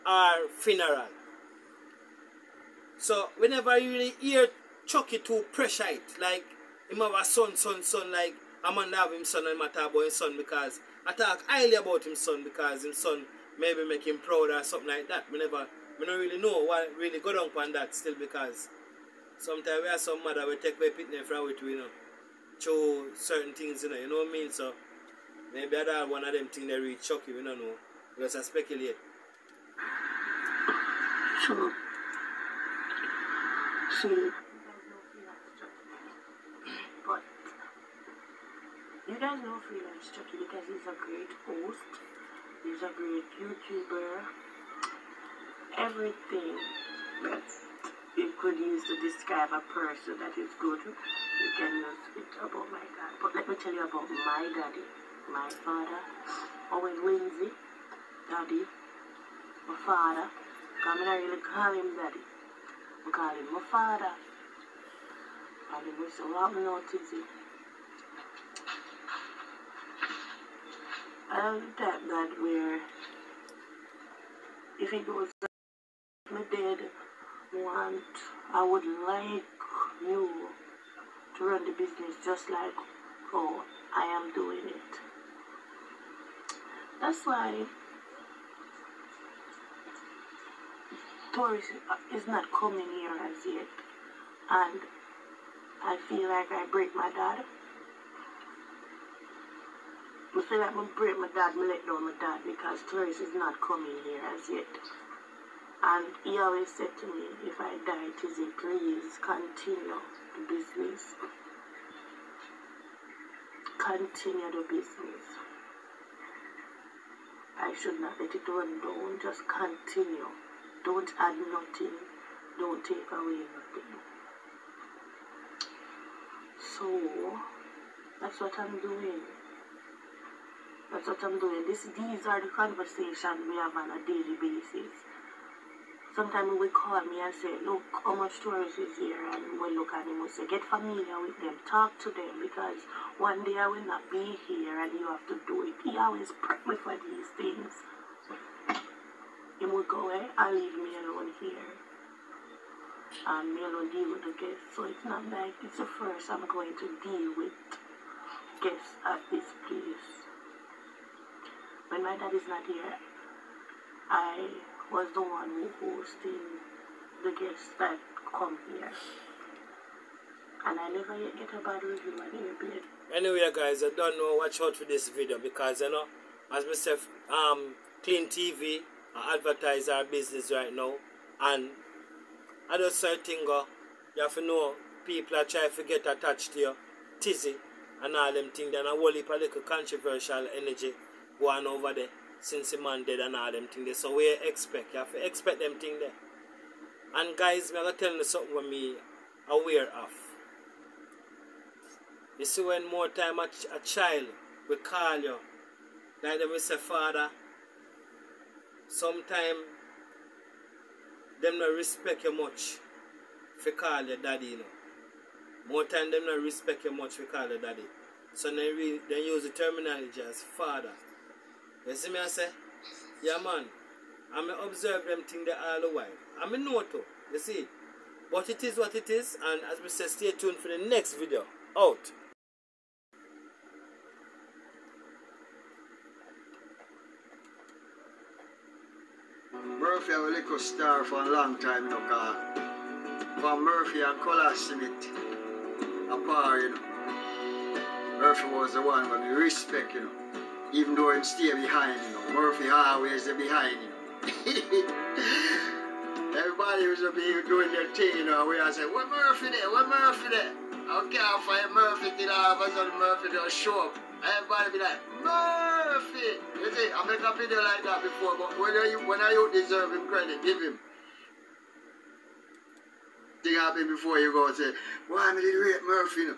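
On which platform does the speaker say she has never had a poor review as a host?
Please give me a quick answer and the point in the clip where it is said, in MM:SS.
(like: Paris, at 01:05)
Airplane, at 02:52.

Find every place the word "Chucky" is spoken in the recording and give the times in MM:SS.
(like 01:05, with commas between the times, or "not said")
00:04, 00:40.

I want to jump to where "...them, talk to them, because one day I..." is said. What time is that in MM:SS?
02:21.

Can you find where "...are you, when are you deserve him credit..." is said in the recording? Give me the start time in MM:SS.
04:28.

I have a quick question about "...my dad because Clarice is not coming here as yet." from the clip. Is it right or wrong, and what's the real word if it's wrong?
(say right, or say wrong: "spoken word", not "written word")
right.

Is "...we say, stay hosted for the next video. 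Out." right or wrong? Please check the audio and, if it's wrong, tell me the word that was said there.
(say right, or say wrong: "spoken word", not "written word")
wrong: "tuned", not "hosted".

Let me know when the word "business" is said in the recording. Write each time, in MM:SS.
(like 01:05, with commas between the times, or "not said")
01:21, 01:50, 01:54, 03:00.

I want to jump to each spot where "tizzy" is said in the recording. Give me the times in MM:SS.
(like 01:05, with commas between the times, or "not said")
01:48, 03:07.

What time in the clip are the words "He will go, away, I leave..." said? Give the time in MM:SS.
02:29.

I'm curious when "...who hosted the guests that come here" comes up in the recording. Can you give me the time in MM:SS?
02:45.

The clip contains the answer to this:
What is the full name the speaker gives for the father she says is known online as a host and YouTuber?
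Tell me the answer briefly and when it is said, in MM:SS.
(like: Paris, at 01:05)
Owen Lindsay, at 00:56.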